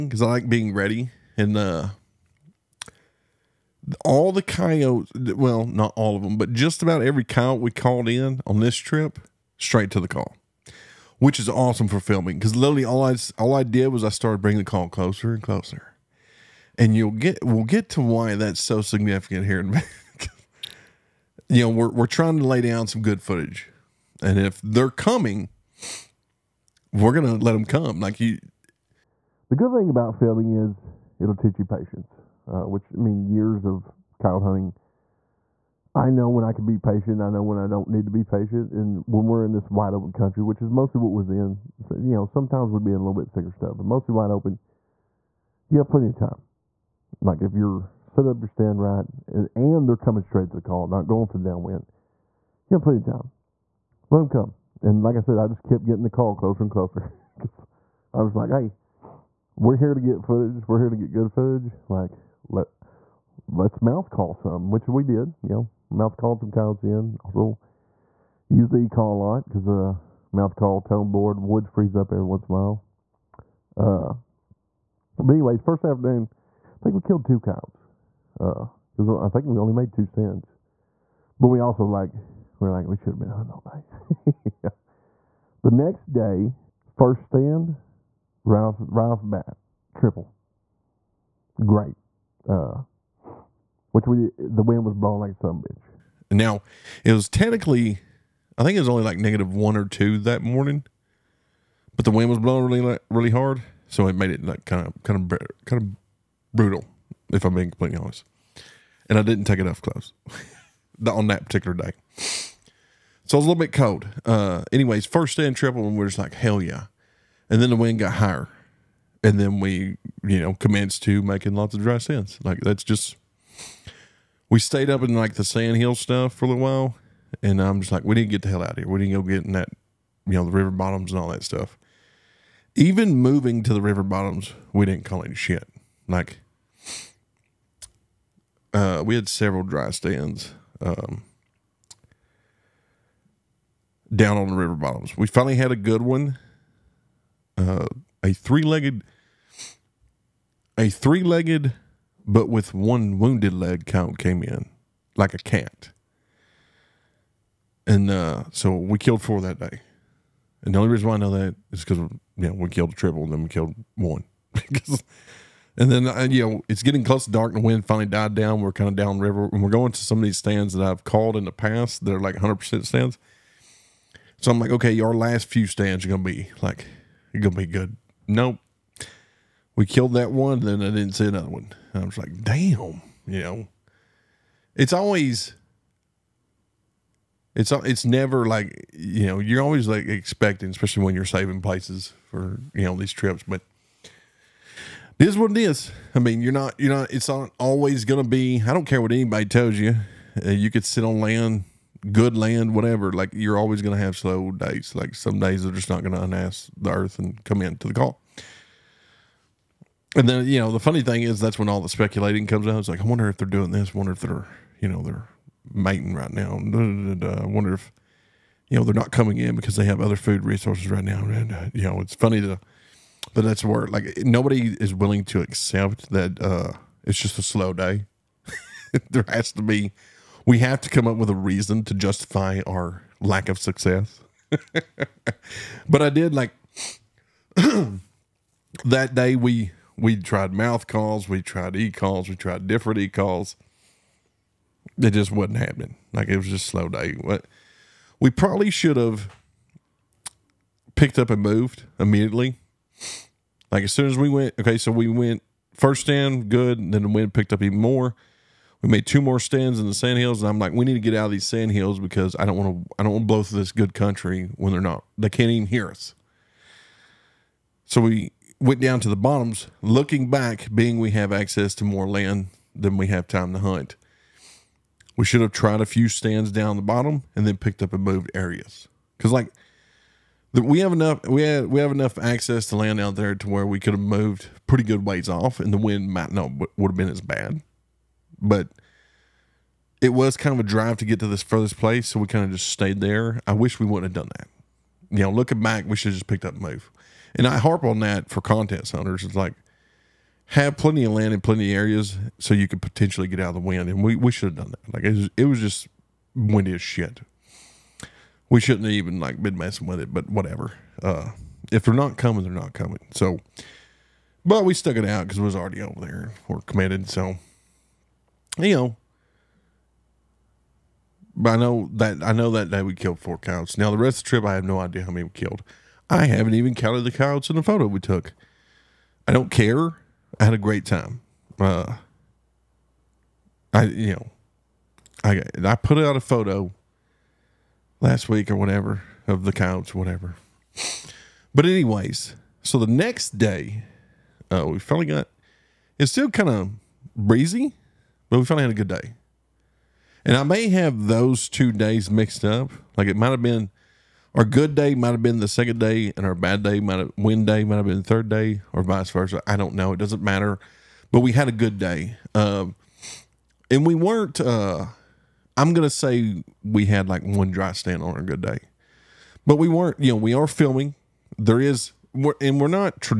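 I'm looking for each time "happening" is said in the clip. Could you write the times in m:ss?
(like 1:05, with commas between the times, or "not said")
4:05.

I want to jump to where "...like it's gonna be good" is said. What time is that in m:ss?
2:56.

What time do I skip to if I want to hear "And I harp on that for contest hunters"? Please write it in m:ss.
4:57.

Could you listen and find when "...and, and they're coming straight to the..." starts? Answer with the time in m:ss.
0:49.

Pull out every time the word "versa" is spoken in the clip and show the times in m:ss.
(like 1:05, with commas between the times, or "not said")
5:59.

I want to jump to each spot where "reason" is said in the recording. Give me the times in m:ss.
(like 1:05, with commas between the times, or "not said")
2:40, 3:51.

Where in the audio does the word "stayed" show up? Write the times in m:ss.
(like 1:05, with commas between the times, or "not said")
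2:04, 4:52.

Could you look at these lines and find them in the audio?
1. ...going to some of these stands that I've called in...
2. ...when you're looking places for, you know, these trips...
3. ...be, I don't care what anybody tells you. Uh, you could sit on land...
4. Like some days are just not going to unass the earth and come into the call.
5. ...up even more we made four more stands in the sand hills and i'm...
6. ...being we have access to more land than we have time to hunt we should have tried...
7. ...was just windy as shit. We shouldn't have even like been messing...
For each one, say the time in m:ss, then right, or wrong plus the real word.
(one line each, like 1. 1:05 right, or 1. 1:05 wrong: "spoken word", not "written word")
1. 2:49 right
2. 3:11 wrong: "saving", not "looking"
3. 3:18 right
4. 3:24 right
5. 4:17 wrong: "two", not "four"
6. 4:30 right
7. 5:05 right.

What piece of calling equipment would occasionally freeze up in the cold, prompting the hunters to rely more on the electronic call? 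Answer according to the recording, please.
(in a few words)
Mouth call tone board.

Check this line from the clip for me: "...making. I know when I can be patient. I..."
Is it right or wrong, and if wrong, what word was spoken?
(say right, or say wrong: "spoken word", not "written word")
wrong: "hunting", not "making".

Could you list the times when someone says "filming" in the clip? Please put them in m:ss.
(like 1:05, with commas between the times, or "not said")
0:11, 0:30, 6:10.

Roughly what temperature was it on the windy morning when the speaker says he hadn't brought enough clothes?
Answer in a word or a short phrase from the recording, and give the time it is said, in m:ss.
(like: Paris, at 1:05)
Negative 1 or 2, at 1:39.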